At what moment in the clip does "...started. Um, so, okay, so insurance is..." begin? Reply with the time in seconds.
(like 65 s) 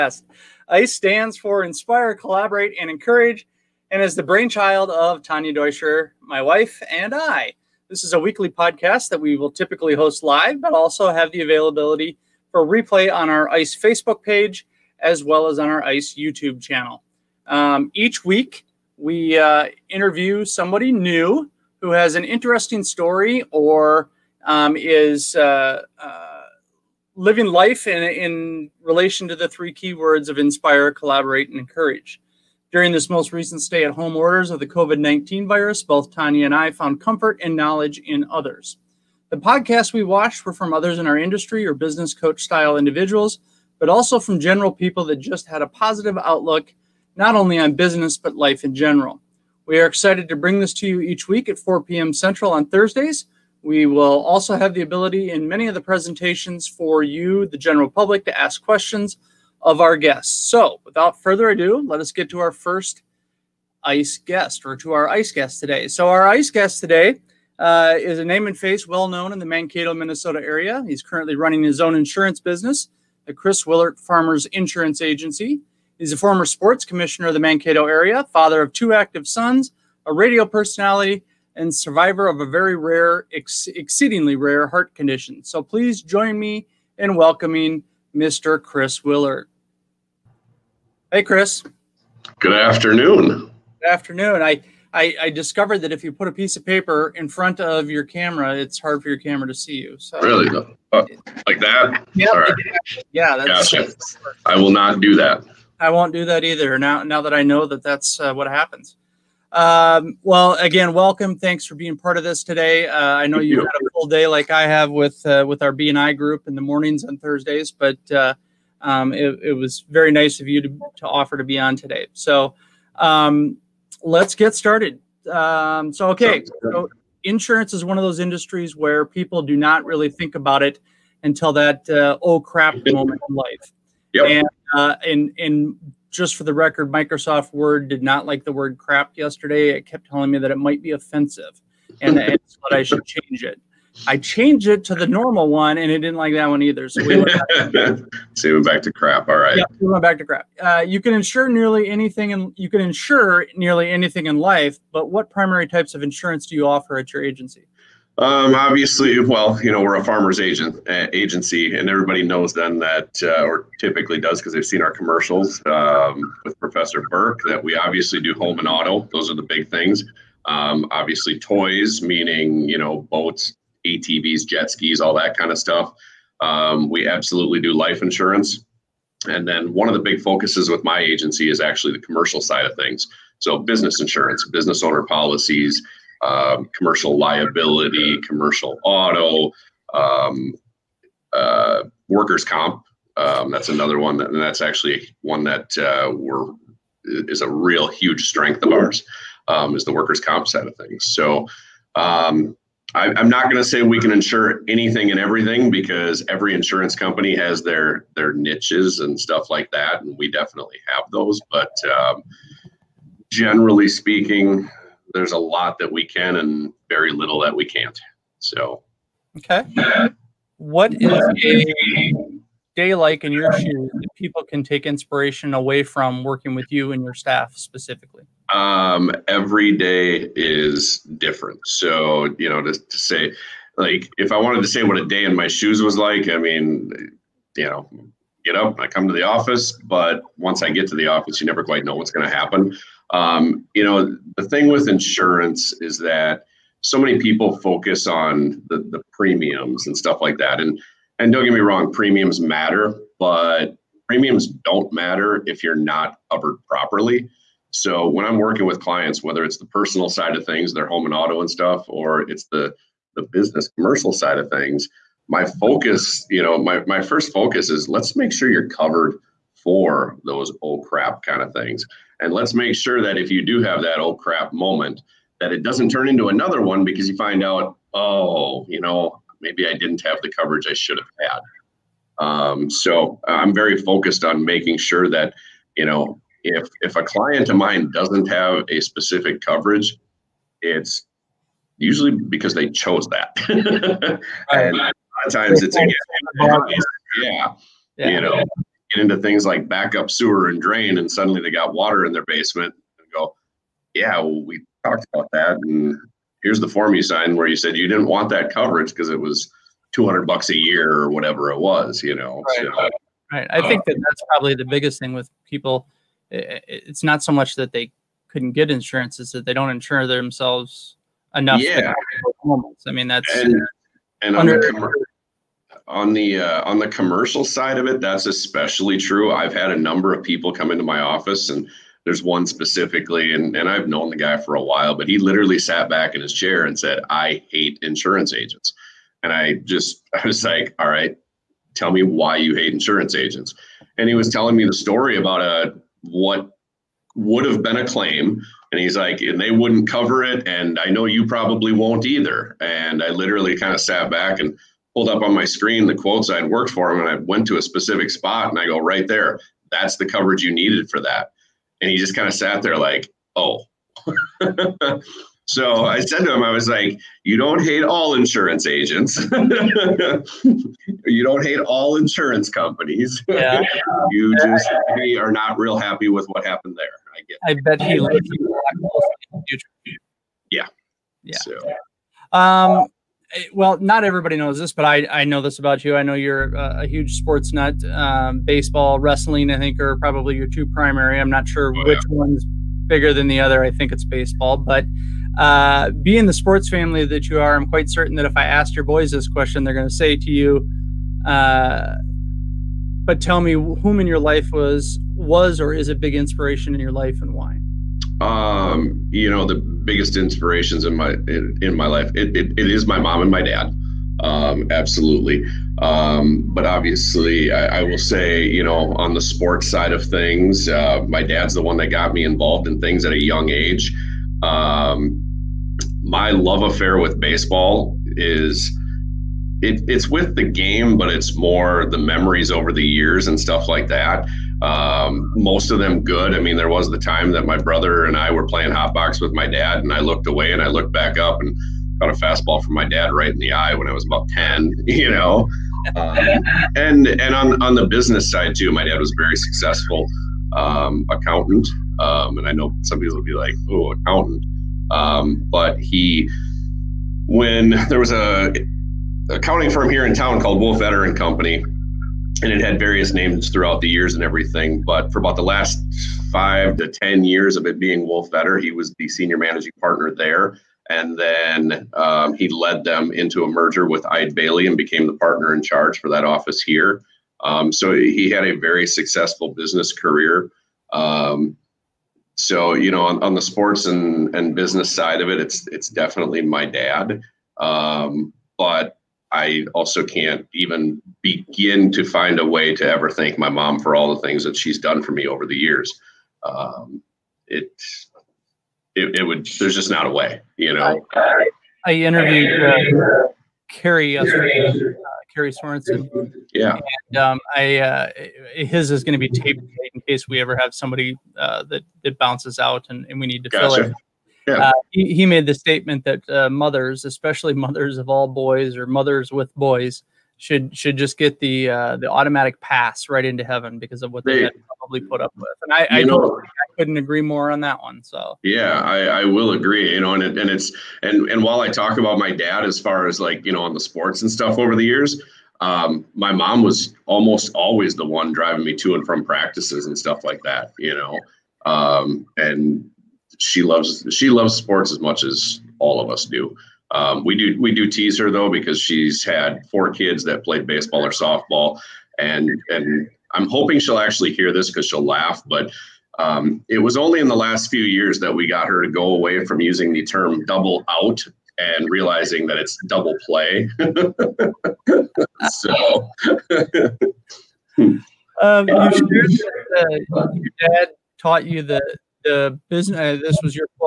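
124 s.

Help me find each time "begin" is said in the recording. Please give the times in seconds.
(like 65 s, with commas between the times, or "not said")
491 s.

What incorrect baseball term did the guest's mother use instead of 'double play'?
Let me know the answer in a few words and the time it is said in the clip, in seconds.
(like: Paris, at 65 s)
Double out, at 560 s.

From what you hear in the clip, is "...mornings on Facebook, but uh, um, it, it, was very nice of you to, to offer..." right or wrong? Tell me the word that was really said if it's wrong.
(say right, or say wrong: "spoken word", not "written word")
wrong: "Thursdays", not "Facebook".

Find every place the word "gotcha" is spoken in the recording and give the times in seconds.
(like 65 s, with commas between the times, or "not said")
103 s, 513 s.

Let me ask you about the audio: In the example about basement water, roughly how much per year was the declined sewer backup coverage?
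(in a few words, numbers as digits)
200 bucks.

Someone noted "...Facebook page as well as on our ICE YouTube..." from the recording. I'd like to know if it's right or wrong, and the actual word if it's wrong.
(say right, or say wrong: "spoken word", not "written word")
right.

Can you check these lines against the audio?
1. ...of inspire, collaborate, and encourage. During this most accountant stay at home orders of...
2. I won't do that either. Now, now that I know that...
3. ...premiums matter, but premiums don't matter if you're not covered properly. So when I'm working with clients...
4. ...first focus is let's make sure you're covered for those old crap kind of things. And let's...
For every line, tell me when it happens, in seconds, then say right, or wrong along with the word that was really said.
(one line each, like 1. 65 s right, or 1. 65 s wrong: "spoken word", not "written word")
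1. 30 s wrong: "recent", not "accountant"
2. 105 s right
3. 251 s right
4. 267 s right.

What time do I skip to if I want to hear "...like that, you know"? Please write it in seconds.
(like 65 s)
540 s.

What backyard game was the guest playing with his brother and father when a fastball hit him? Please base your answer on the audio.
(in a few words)
Hot box.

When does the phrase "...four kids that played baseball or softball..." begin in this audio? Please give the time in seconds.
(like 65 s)
549 s.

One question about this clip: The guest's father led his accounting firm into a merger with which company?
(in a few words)
Eide Bailly.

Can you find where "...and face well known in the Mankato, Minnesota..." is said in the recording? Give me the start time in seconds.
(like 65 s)
68 s.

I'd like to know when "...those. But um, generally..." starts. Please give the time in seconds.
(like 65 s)
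211 s.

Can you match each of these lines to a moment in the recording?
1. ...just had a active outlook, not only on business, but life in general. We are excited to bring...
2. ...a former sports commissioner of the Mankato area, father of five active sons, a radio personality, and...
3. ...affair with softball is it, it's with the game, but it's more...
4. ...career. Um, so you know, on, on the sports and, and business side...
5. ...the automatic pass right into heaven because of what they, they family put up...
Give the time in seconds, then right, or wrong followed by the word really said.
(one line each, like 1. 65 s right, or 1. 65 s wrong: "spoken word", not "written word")
1. 45 s wrong: "positive", not "active"
2. 76 s wrong: "two", not "five"
3. 426 s wrong: "baseball", not "softball"
4. 479 s right
5. 521 s wrong: "probably", not "family".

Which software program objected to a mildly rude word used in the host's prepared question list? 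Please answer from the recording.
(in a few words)
Microsoft Word.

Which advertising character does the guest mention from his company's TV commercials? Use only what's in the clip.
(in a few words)
Professor Burke.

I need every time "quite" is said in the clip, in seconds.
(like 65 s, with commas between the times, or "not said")
241 s, 397 s.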